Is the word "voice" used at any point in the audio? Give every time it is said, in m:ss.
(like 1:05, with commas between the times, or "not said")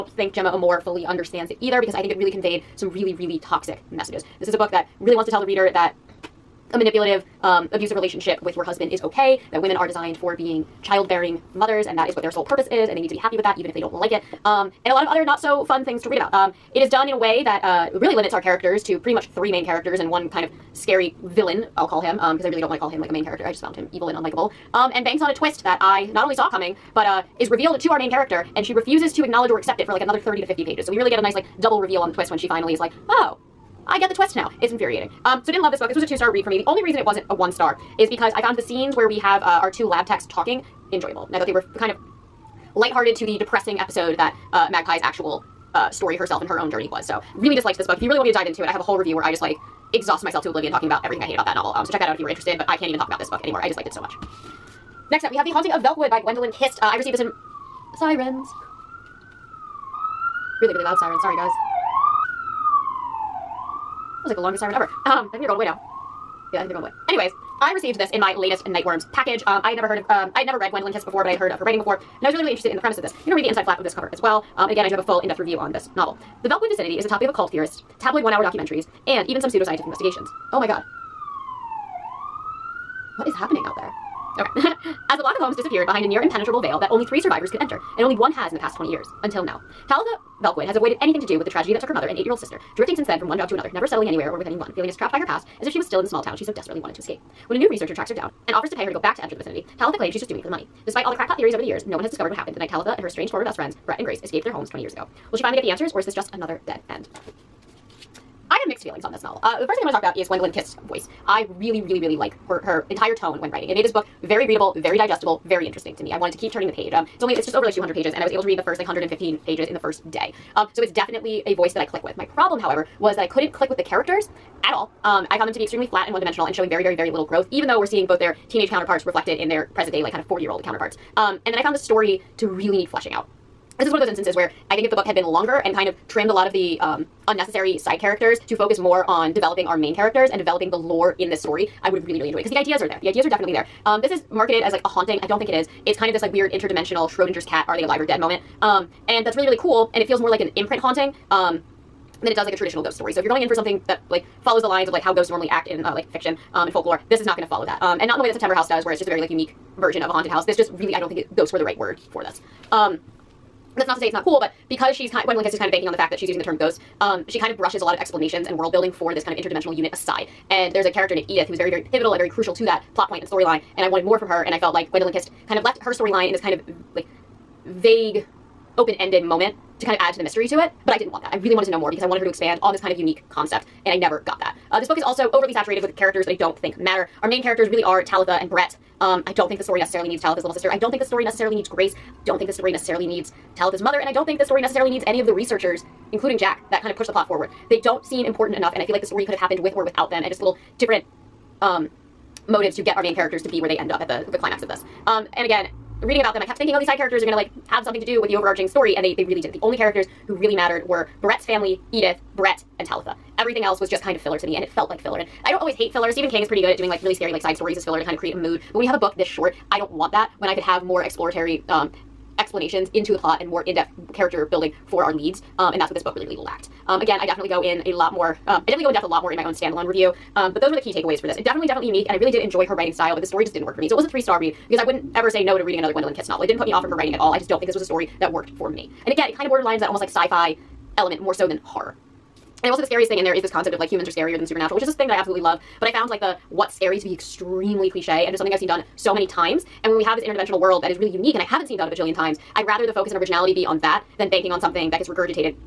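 1:50, 2:01.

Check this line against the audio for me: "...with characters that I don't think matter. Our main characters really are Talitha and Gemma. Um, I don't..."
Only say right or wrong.
wrong.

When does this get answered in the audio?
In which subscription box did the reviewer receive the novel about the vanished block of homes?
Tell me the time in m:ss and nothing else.
1:08.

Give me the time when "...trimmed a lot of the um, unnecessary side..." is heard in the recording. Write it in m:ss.
2:16.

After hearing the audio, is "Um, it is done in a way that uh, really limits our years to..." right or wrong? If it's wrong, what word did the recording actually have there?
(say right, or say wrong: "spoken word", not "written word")
wrong: "characters", not "years".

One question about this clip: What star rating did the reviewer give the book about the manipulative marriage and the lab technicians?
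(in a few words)
2 stars.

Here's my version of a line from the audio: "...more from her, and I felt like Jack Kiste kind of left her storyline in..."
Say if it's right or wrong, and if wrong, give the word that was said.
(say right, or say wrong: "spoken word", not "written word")
wrong: "Gwendolyn", not "Jack".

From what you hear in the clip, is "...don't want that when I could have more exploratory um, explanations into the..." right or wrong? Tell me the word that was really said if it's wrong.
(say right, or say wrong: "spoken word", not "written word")
right.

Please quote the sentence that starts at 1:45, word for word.
Will she finally get the answers or is this just another dead end?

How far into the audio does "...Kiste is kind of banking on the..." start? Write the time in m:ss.
2:45.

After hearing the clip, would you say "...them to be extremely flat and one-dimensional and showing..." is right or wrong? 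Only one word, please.
right.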